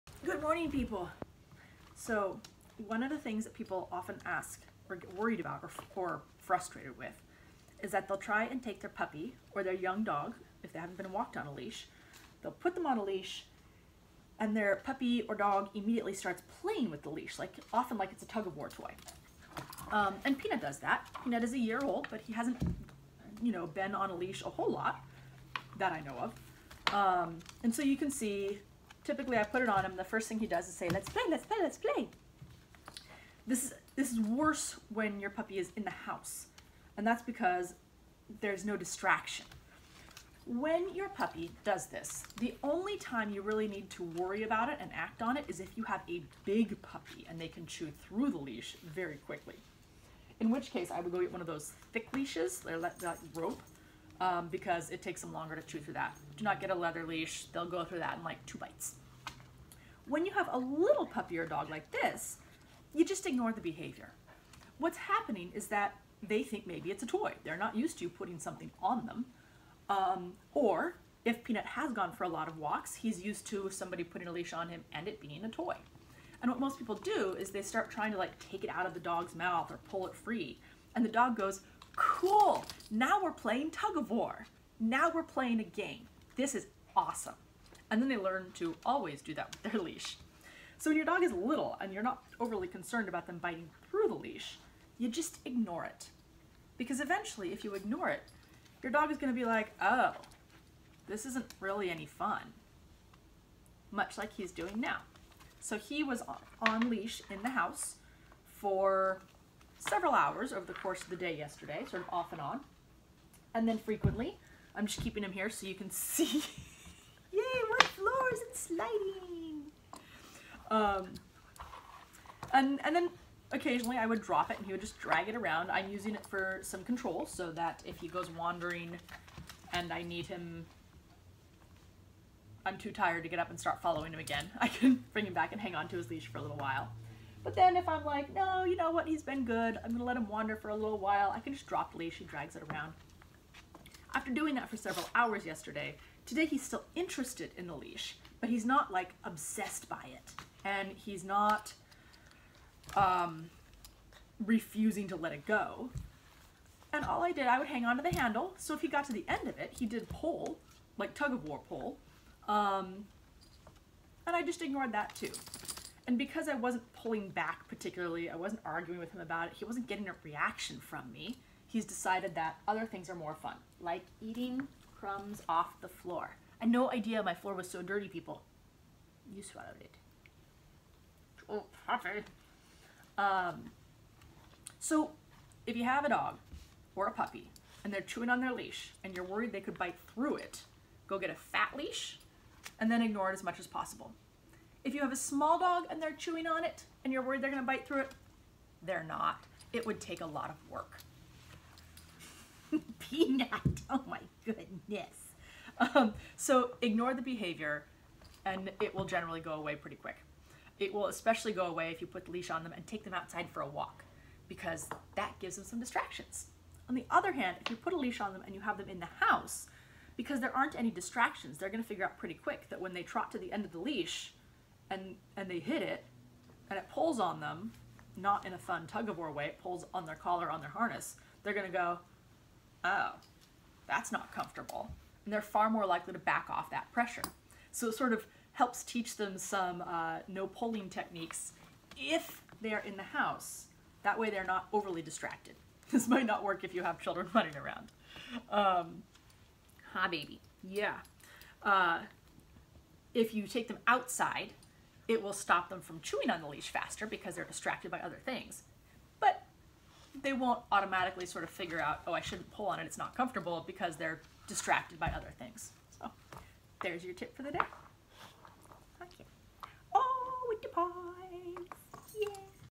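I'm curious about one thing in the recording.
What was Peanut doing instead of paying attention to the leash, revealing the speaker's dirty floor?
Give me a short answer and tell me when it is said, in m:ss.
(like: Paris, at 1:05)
eating crumbs, at 2:54.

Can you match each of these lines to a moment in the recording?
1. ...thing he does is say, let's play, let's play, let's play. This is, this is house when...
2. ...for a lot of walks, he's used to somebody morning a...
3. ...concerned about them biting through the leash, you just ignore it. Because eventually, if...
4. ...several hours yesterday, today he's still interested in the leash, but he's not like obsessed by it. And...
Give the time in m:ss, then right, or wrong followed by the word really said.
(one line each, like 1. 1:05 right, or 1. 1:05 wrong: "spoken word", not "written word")
1. 0:30 wrong: "worse", not "house"
2. 1:12 wrong: "putting", not "morning"
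3. 1:32 right
4. 2:24 right.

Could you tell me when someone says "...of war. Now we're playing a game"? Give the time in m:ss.
1:23.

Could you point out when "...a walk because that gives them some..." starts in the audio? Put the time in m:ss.
3:33.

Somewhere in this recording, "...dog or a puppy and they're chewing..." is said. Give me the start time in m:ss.
3:06.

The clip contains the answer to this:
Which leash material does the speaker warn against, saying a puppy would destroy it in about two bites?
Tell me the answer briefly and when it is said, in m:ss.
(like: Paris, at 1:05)
leather, at 0:56.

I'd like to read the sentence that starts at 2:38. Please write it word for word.
So if he got to the end of it, he did pull, like tug of war pull.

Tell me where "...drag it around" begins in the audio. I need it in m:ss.
2:04.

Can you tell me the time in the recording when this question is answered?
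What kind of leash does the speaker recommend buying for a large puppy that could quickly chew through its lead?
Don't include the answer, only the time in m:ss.
0:53.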